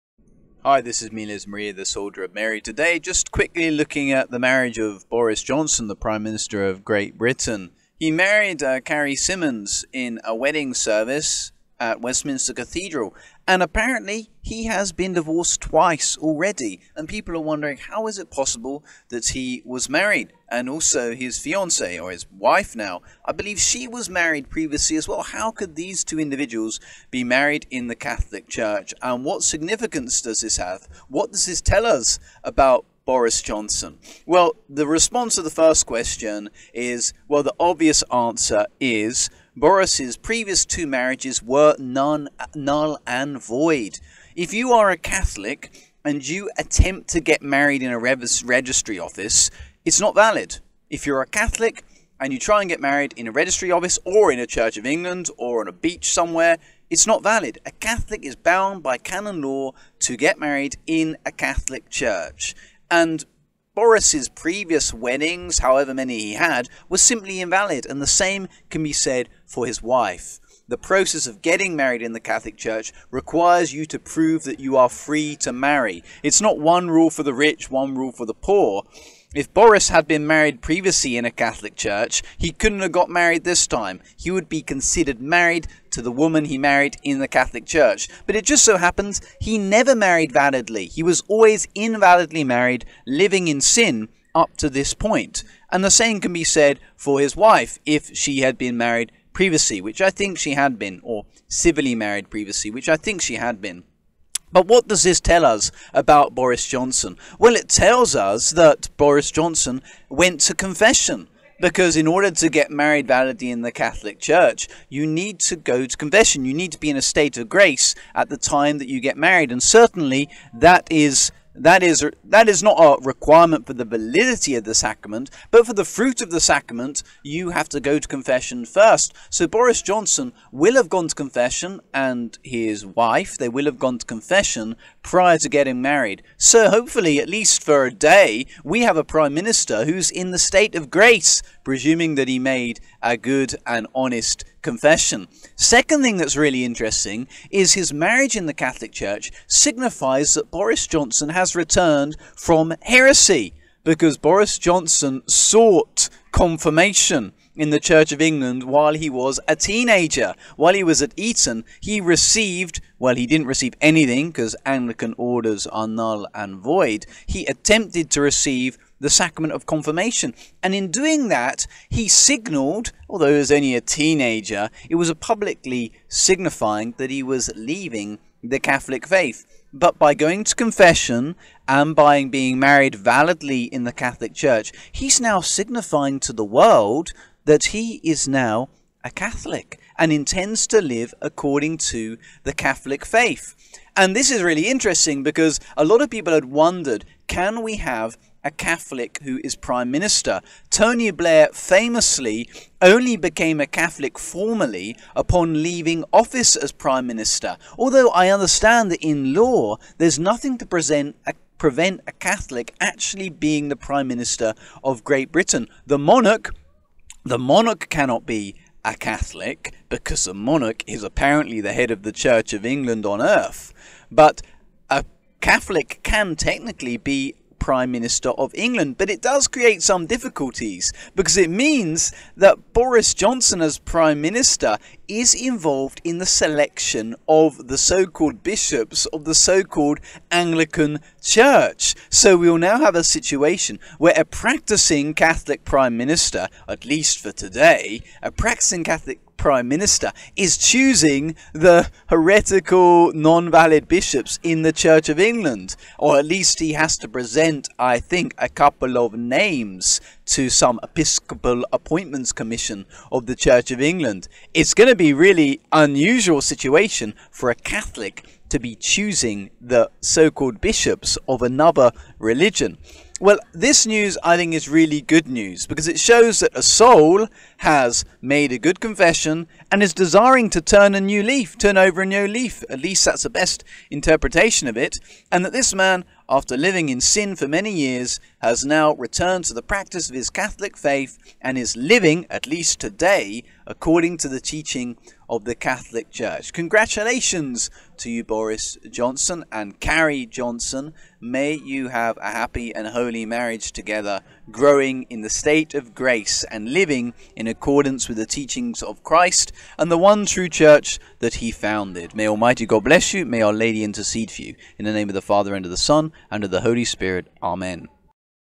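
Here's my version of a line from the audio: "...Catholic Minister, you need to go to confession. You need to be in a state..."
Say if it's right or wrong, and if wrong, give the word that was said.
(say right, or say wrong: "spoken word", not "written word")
wrong: "Church", not "Minister".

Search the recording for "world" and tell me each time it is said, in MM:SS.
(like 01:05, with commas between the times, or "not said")
03:06.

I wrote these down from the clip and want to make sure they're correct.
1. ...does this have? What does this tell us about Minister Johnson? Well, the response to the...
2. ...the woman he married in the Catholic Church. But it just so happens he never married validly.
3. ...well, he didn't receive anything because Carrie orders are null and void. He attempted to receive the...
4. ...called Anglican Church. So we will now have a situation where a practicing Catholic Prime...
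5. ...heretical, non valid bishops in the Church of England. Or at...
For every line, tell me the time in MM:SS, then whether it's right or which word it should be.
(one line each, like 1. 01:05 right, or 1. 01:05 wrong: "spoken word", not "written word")
1. 00:30 wrong: "Boris", not "Minister"
2. 01:26 right
3. 02:42 wrong: "Anglican", not "Carrie"
4. 03:59 right
5. 04:12 right.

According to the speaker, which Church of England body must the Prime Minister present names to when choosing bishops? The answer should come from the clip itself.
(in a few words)
Episcopal Appointments Commission.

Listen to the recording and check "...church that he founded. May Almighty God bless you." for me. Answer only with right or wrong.
right.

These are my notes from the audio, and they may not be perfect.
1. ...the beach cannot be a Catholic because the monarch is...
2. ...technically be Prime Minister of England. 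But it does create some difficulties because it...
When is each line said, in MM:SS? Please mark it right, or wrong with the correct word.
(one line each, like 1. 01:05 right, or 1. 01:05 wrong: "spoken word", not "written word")
1. 03:37 wrong: "monarch", not "beach"
2. 03:46 right.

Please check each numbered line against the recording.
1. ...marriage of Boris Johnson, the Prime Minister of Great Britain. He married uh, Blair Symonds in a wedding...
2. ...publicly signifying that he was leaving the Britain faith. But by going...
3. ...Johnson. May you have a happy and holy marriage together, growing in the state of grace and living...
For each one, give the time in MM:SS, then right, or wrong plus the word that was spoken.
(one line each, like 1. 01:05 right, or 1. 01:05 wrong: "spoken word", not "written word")
1. 00:04 wrong: "Carrie", not "Blair"
2. 02:55 wrong: "Catholic", not "Britain"
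3. 05:00 right.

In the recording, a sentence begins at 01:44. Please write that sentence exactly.
But what does this tell us about Boris Johnson?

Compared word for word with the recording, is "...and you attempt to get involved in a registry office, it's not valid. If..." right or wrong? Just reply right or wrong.
wrong.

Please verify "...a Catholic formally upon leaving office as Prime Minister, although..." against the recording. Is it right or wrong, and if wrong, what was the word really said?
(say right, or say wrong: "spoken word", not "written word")
right.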